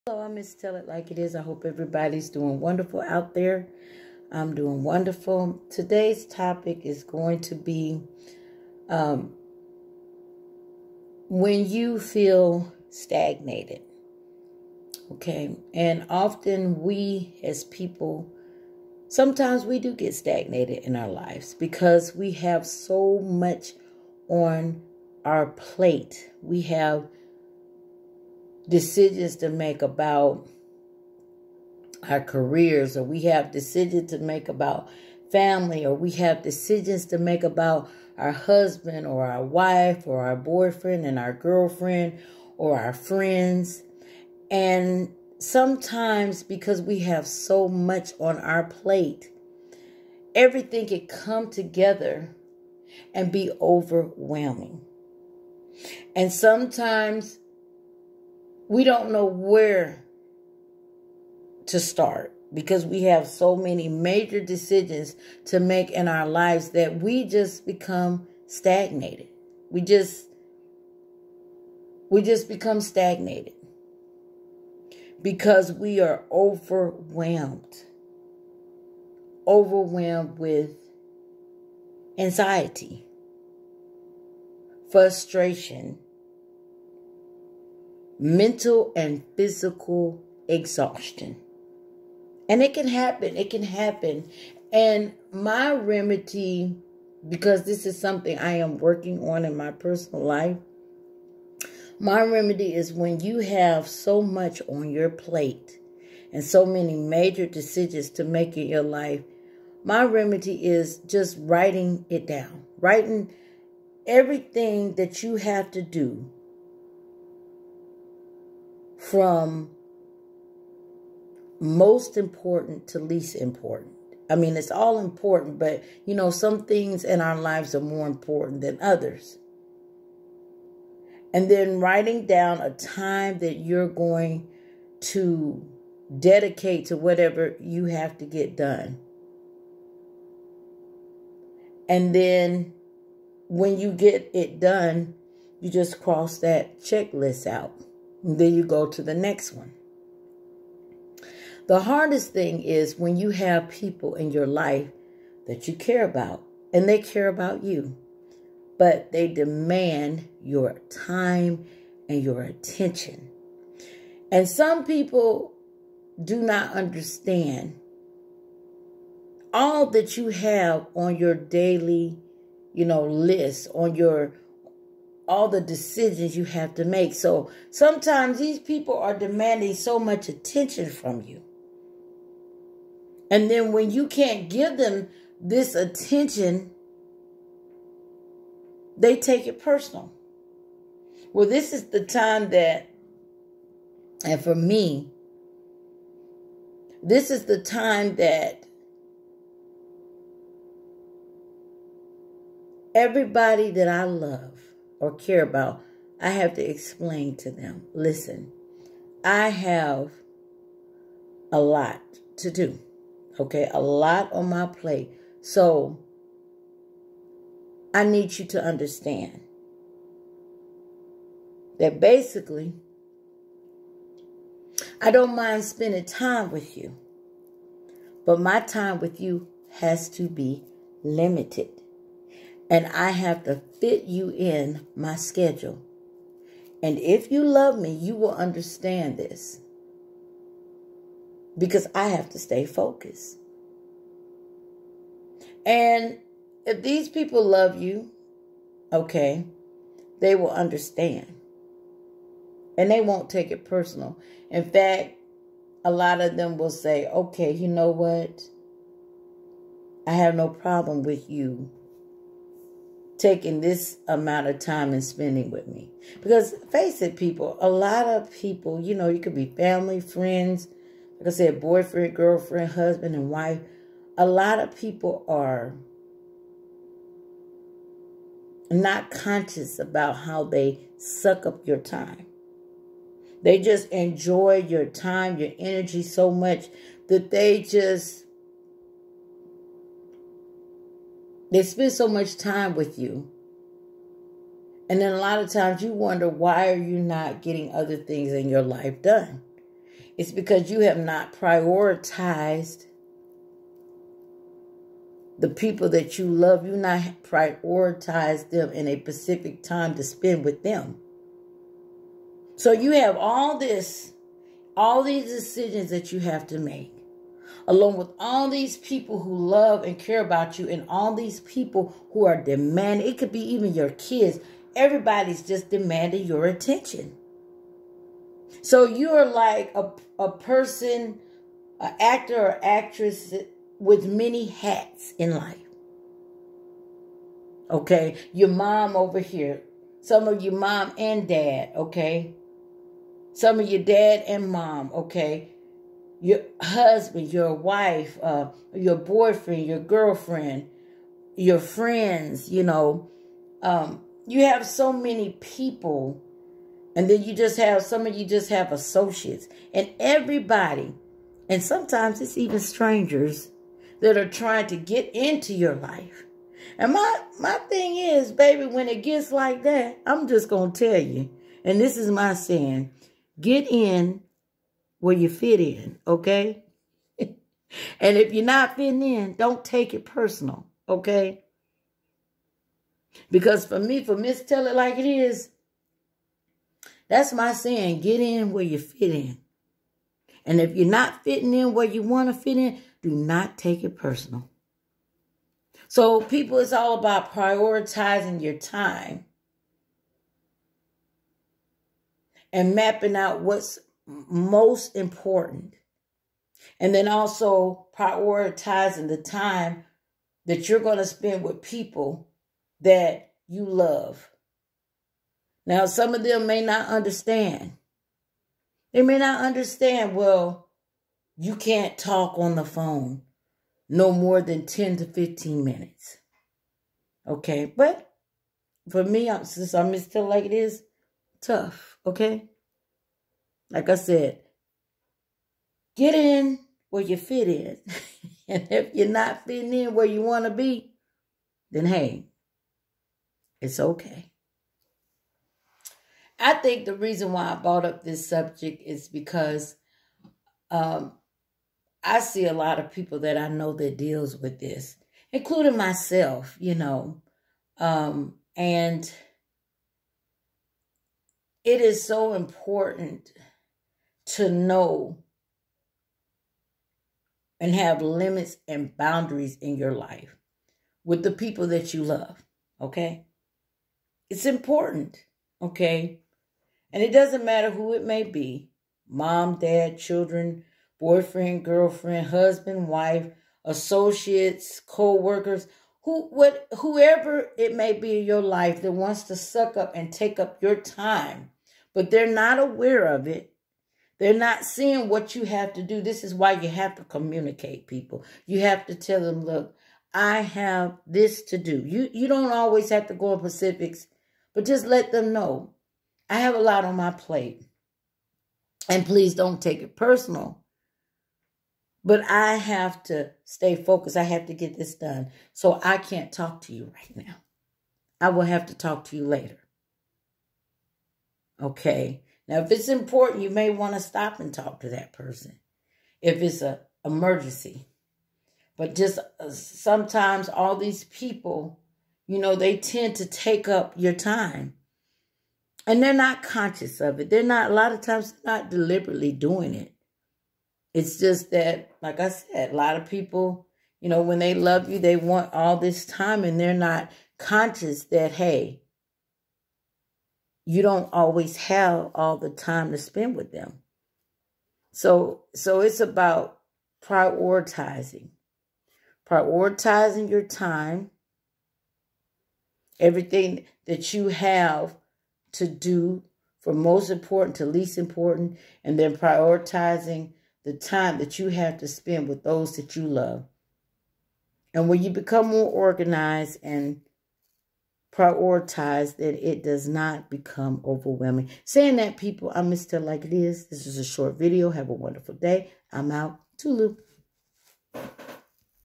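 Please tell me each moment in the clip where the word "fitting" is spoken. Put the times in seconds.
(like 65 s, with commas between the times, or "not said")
378 s, 391 s, 439 s.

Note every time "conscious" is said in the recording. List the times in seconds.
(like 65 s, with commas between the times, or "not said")
279 s, 536 s, 547 s.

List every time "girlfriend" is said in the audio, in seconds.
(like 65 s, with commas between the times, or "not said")
41 s, 272 s, 349 s, 481 s.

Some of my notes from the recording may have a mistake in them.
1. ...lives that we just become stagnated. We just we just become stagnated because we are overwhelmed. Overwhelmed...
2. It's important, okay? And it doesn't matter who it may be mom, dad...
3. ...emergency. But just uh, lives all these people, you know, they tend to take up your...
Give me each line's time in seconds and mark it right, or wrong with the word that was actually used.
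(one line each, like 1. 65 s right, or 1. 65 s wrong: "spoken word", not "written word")
1. 66 s right
2. 474 s right
3. 527 s wrong: "sometimes", not "lives".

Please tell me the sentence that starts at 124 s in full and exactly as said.
I mean, it's all important, but you know, some things in our lives are more important than others.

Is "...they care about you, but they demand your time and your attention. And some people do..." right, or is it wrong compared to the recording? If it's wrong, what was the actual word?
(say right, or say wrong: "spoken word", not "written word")
right.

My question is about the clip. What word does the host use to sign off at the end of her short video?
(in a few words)
Toodaloo.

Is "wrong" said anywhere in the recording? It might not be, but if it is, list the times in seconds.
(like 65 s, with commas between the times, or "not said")
not said.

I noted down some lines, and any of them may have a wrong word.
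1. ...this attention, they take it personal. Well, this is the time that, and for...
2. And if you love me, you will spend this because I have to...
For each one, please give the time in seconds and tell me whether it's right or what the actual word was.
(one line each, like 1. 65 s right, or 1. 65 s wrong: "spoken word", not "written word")
1. 185 s right
2. 236 s wrong: "understand", not "spend".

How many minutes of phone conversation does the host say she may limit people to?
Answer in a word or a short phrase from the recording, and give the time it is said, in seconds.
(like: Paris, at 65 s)
10 to 15 minutes, at 424 s.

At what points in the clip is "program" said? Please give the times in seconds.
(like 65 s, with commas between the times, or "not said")
not said.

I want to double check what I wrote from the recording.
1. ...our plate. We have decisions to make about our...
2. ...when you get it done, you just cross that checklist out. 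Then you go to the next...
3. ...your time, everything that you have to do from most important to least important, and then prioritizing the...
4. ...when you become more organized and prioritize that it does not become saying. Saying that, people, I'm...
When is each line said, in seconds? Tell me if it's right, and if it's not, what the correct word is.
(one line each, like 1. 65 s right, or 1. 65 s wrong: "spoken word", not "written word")
1. 25 s right
2. 143 s right
3. 560 s right
4. 574 s wrong: "overwhelming", not "saying".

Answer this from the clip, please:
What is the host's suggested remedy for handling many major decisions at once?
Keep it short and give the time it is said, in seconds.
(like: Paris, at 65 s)
Writing it down, at 111 s.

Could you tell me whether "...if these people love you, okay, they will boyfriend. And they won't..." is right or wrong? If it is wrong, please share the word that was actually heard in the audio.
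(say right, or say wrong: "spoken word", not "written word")
wrong: "understand", not "boyfriend".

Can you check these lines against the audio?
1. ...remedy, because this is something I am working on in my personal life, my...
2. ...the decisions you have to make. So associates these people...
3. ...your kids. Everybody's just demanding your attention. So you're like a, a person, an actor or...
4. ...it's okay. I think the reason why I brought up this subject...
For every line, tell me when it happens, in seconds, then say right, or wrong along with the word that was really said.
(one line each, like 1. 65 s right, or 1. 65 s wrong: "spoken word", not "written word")
1. 95 s right
2. 175 s wrong: "sometimes", not "associates"
3. 323 s right
4. 443 s right.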